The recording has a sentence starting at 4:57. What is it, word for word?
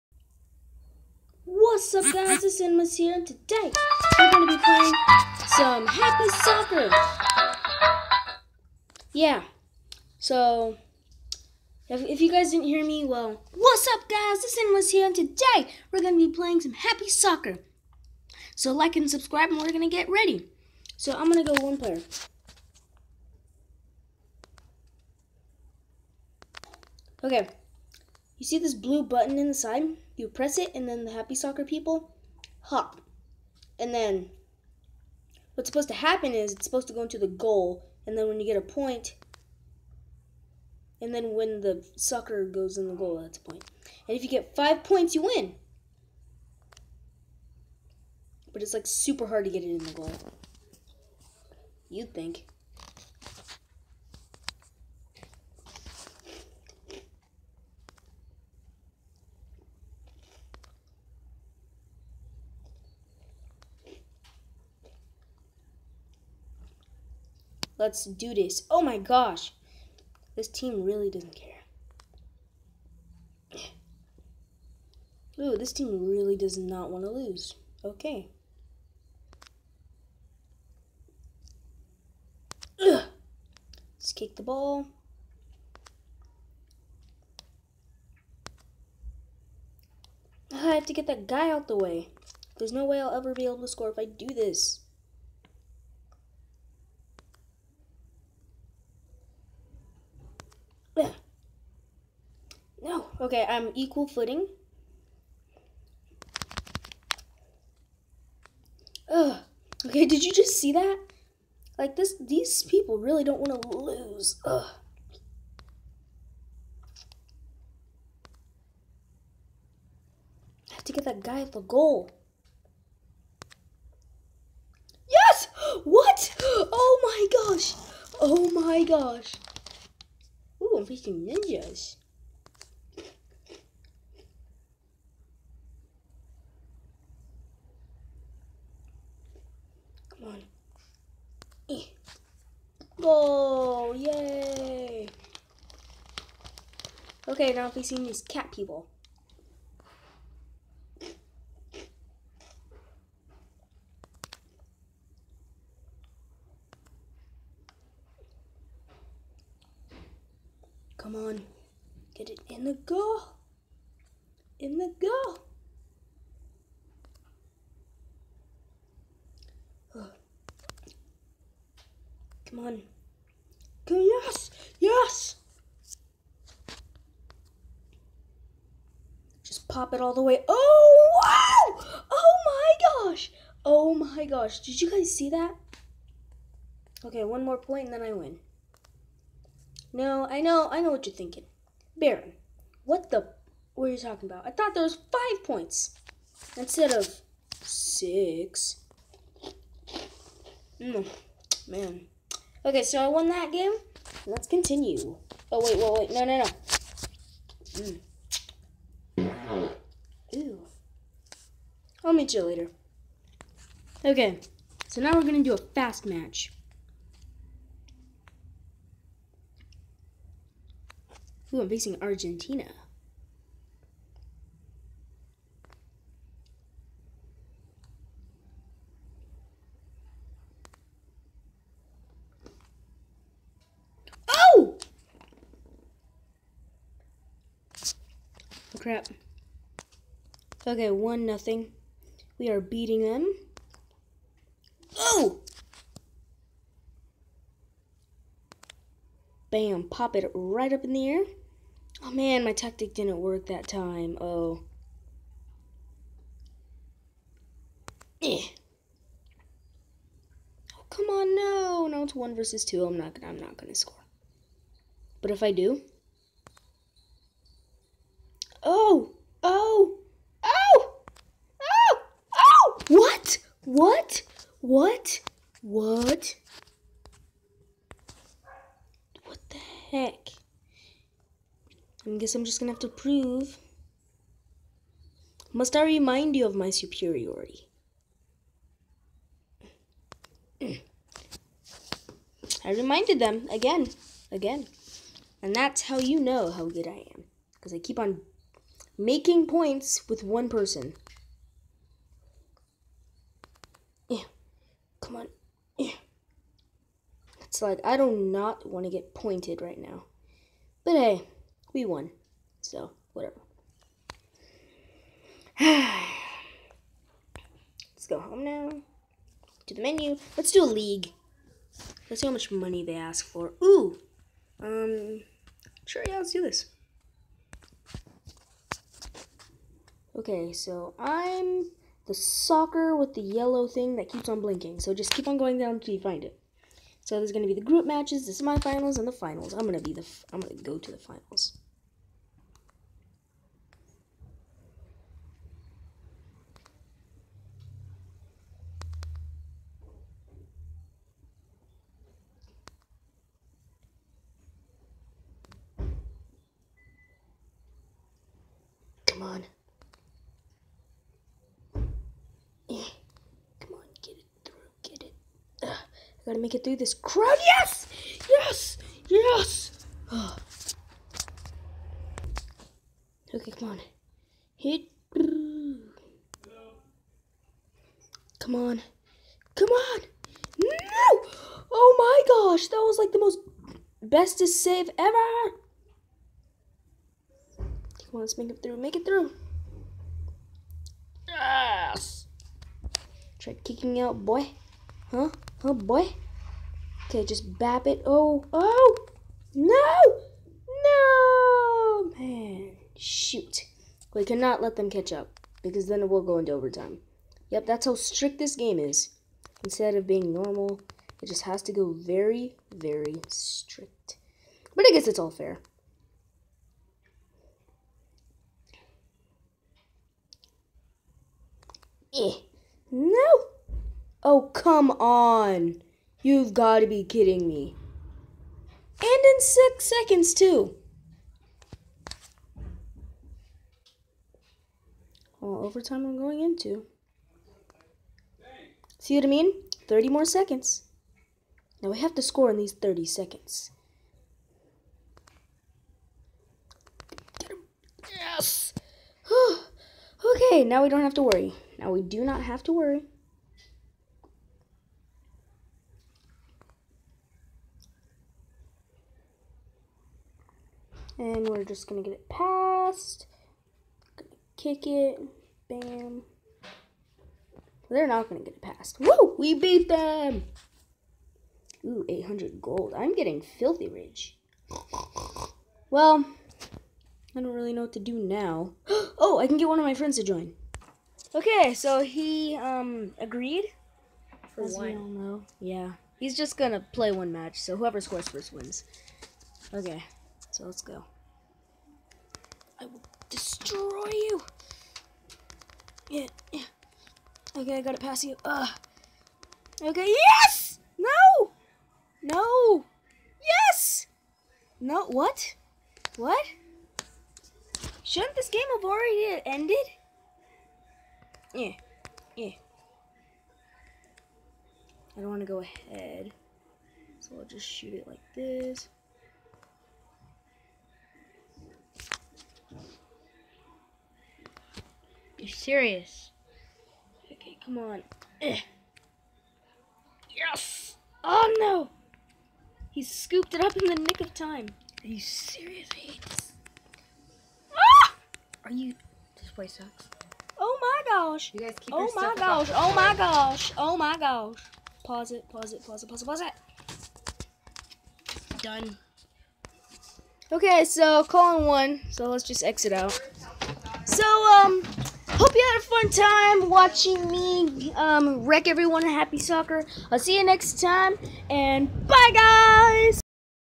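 Because I keep on making points with one person.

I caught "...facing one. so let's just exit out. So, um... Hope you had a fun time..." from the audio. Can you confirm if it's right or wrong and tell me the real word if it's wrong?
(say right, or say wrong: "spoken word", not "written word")
wrong: "calling", not "facing".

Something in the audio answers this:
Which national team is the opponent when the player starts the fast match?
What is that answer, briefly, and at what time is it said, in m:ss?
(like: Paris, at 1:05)
Argentina, at 3:42.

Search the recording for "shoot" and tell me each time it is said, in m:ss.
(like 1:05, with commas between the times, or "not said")
6:42, 8:37.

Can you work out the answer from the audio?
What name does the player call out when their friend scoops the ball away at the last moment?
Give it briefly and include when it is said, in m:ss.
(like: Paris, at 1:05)
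Hades, at 8:55.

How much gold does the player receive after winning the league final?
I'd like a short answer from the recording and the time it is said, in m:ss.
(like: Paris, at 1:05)
800, at 7:52.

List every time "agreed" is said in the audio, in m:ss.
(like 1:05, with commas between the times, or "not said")
8:03.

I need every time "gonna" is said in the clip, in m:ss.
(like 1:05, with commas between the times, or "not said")
4:23, 4:42, 8:06.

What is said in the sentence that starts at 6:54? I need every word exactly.
But I guess it's all fair.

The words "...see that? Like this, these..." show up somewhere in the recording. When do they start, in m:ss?
1:50.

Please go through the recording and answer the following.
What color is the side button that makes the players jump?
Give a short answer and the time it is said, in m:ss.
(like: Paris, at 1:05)
Blue, at 0:28.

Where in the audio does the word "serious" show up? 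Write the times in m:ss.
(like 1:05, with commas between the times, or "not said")
8:45, 8:55.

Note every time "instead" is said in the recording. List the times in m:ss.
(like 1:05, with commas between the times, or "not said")
3:16, 6:49.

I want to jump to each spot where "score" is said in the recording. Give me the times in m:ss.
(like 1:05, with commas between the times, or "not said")
1:33, 4:23, 7:22, 8:08.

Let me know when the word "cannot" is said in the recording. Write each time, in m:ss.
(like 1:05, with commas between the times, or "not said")
6:44.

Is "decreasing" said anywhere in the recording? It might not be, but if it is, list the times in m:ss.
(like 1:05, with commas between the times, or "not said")
not said.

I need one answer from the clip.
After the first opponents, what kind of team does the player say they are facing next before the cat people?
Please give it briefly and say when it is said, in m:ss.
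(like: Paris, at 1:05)
Ninjas, at 2:11.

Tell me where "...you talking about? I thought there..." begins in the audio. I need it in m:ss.
3:13.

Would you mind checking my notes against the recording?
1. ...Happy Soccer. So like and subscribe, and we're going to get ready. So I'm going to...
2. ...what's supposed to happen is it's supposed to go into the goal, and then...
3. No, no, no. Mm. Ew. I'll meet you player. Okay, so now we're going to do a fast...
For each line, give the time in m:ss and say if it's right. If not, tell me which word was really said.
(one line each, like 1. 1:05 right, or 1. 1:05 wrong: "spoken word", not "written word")
1. 0:16 right
2. 0:35 right
3. 3:26 wrong: "later", not "player".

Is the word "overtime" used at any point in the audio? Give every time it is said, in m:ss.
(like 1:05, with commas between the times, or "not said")
6:46, 7:15.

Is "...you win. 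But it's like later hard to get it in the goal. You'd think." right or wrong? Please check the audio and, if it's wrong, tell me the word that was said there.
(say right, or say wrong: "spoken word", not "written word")
wrong: "super", not "later".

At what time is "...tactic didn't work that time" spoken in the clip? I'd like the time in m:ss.
4:12.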